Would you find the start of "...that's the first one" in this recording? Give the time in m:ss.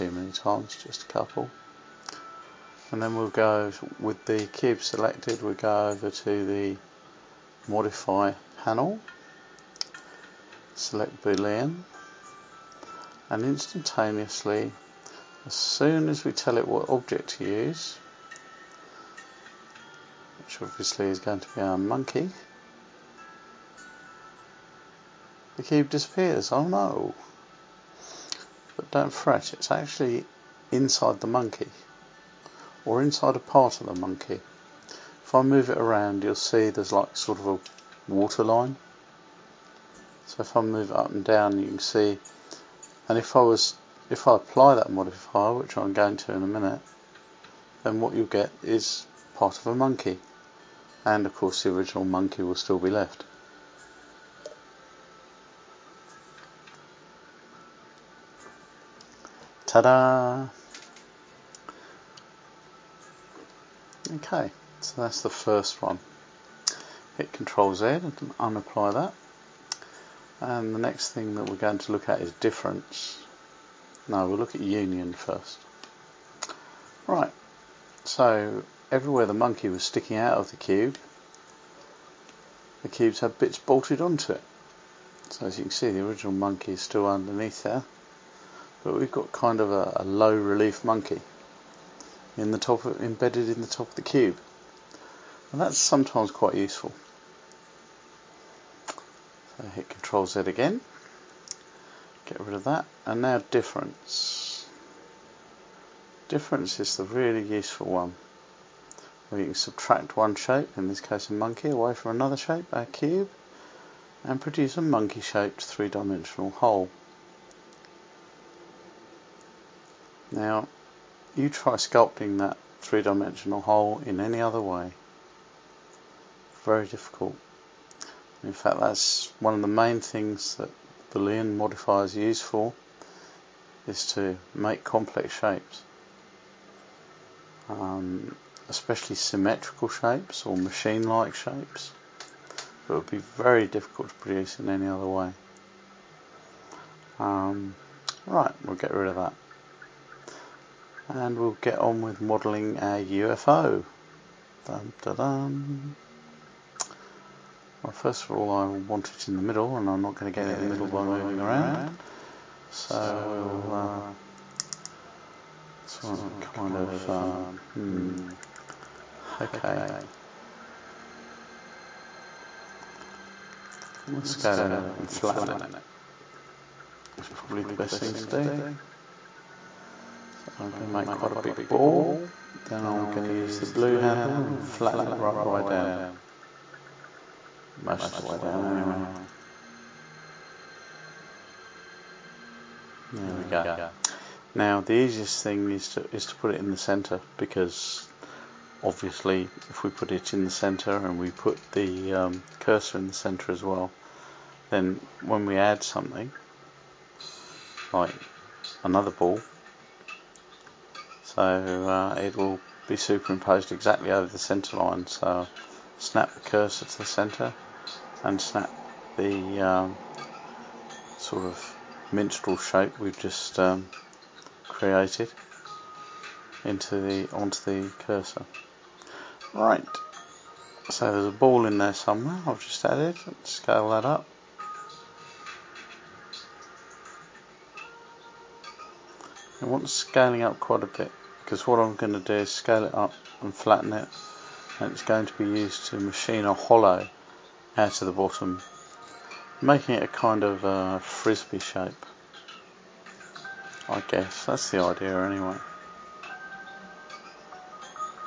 1:05.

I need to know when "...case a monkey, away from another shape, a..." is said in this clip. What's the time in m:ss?
1:50.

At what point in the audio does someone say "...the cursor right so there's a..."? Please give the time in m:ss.
3:47.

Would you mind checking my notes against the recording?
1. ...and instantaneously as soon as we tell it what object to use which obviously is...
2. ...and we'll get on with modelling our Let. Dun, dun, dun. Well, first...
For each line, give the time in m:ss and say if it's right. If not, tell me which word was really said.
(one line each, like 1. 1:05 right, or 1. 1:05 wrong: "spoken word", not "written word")
1. 0:13 right
2. 2:31 wrong: "UFO", not "Let".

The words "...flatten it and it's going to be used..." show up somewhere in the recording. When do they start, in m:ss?
4:03.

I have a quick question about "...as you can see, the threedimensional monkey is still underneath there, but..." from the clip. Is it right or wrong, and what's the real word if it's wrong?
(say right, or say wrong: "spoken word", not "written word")
wrong: "original", not "threedimensional".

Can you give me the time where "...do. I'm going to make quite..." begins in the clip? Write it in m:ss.
2:58.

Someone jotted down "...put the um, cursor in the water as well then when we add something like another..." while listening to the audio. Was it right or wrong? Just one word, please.
wrong.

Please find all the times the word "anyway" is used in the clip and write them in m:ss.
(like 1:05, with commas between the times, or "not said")
3:08, 4:15.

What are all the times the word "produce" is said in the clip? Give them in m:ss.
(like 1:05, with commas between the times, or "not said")
1:54, 2:24.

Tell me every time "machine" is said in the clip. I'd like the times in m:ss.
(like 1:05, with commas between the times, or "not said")
2:20, 4:05.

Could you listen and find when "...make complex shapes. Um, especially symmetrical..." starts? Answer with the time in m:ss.
2:14.